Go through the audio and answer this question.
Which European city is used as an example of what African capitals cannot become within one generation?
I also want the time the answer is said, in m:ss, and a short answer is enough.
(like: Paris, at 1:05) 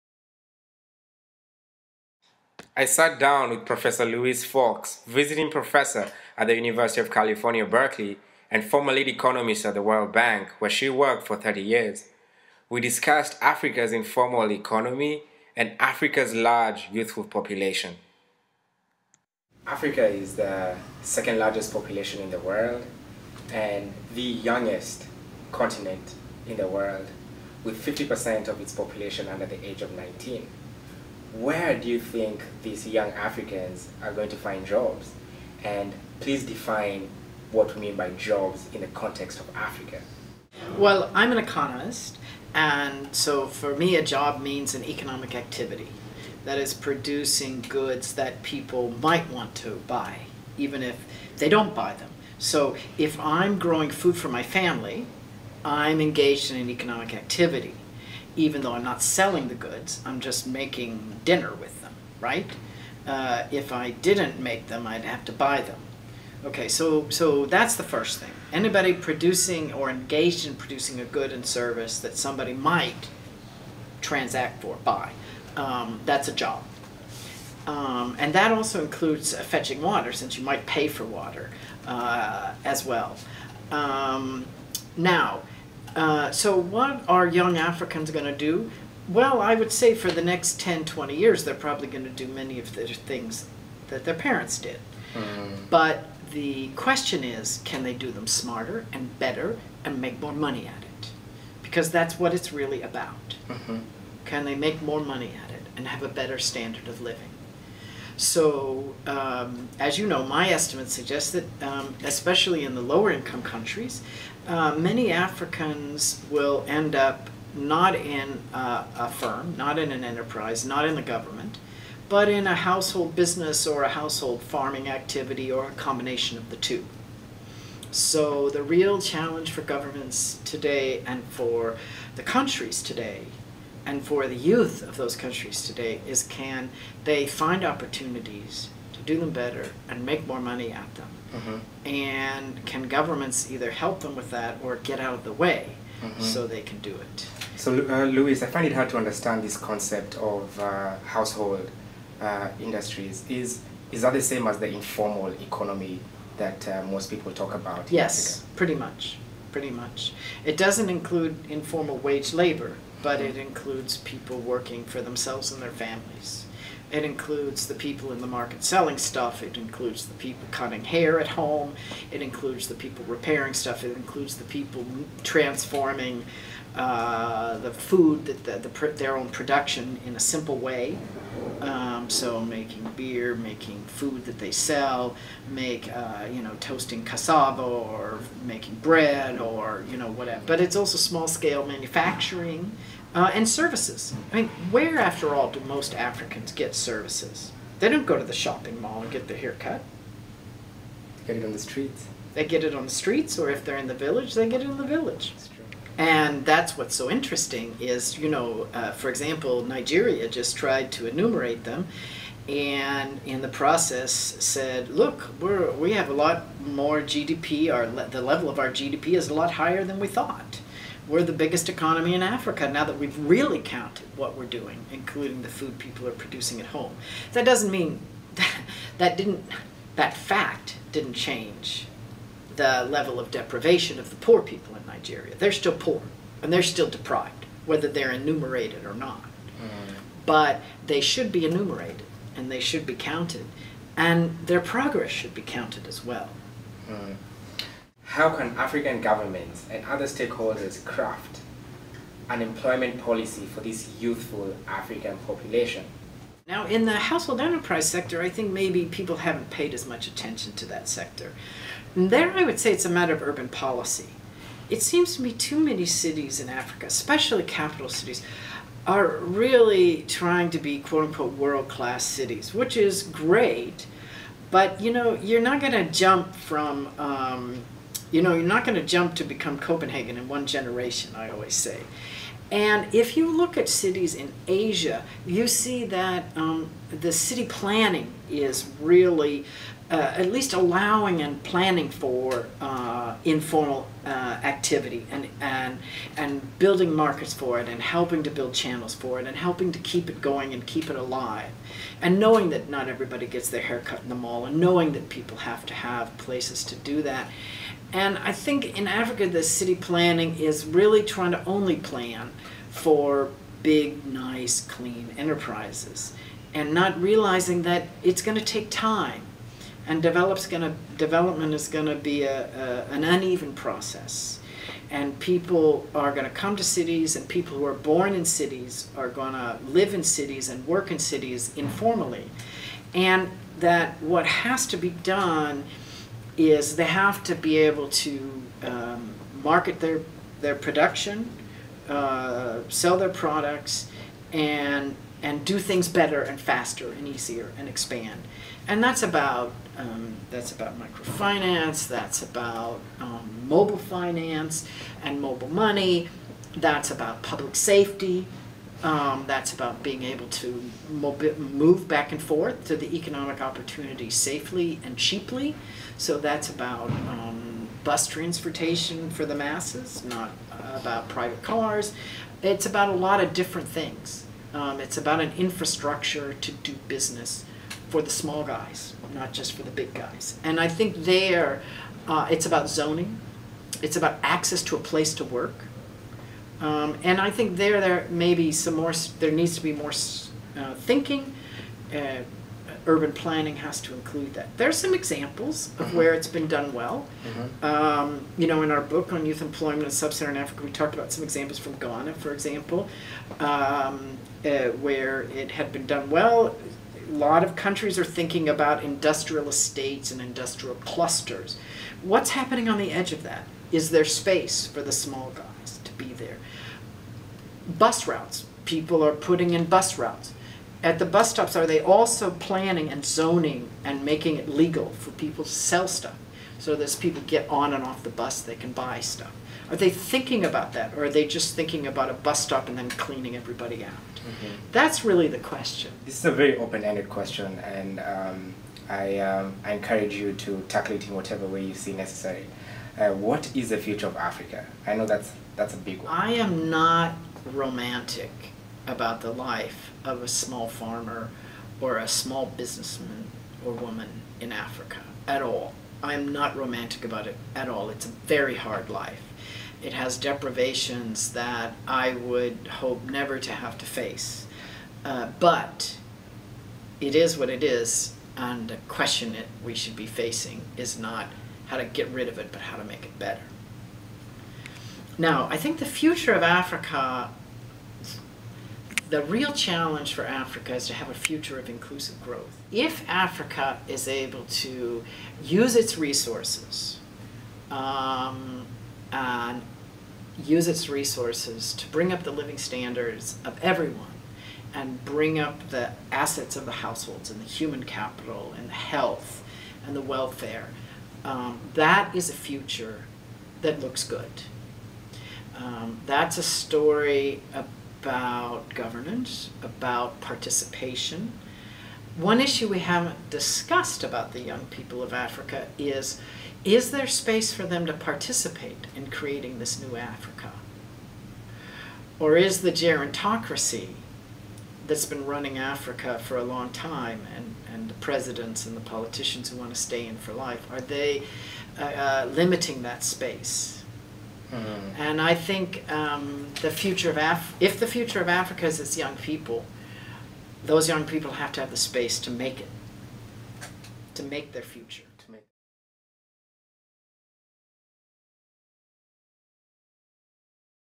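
Copenhagen, at 4:39.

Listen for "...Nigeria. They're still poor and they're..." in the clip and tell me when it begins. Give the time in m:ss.
3:54.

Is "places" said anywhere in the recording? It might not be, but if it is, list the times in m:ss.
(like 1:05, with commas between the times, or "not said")
5:06, 6:24.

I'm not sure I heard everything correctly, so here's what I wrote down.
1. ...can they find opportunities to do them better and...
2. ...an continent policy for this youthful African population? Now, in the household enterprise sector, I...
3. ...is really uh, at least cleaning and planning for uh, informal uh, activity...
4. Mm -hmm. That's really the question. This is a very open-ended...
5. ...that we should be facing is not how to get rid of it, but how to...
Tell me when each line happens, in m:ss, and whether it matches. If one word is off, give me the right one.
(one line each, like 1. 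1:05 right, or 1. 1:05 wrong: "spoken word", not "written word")
1. 2:16 right
2. 4:12 wrong: "employment", not "continent"
3. 4:48 wrong: "allowing", not "cleaning"
4. 7:14 right
5. 7:49 right.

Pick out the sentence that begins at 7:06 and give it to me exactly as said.
So that as people get on and off the bus, they can buy stuff.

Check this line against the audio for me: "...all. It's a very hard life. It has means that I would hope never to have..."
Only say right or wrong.
wrong.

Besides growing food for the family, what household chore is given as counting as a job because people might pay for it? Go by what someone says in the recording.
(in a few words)
fetching water.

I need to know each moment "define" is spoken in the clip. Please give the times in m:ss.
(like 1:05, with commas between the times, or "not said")
0:36.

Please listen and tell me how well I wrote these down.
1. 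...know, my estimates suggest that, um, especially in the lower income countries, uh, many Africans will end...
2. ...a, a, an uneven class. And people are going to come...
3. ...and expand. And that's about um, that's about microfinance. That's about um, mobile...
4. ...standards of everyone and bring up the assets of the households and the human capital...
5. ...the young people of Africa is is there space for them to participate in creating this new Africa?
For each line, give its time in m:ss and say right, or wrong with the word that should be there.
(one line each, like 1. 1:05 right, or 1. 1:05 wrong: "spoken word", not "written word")
1. 1:50 right
2. 5:22 wrong: "process", not "class"
3. 5:47 right
4. 8:12 right
5. 8:34 right.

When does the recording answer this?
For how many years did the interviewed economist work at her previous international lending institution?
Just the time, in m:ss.
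0:11.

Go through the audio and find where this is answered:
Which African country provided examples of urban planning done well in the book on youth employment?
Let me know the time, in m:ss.
6:41.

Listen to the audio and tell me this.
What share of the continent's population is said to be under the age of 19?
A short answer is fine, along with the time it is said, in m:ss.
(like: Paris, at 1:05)
50%, at 0:27.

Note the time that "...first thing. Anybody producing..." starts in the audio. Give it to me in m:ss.
1:07.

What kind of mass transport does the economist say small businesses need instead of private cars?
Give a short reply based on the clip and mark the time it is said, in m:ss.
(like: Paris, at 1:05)
bus transportation, at 6:07.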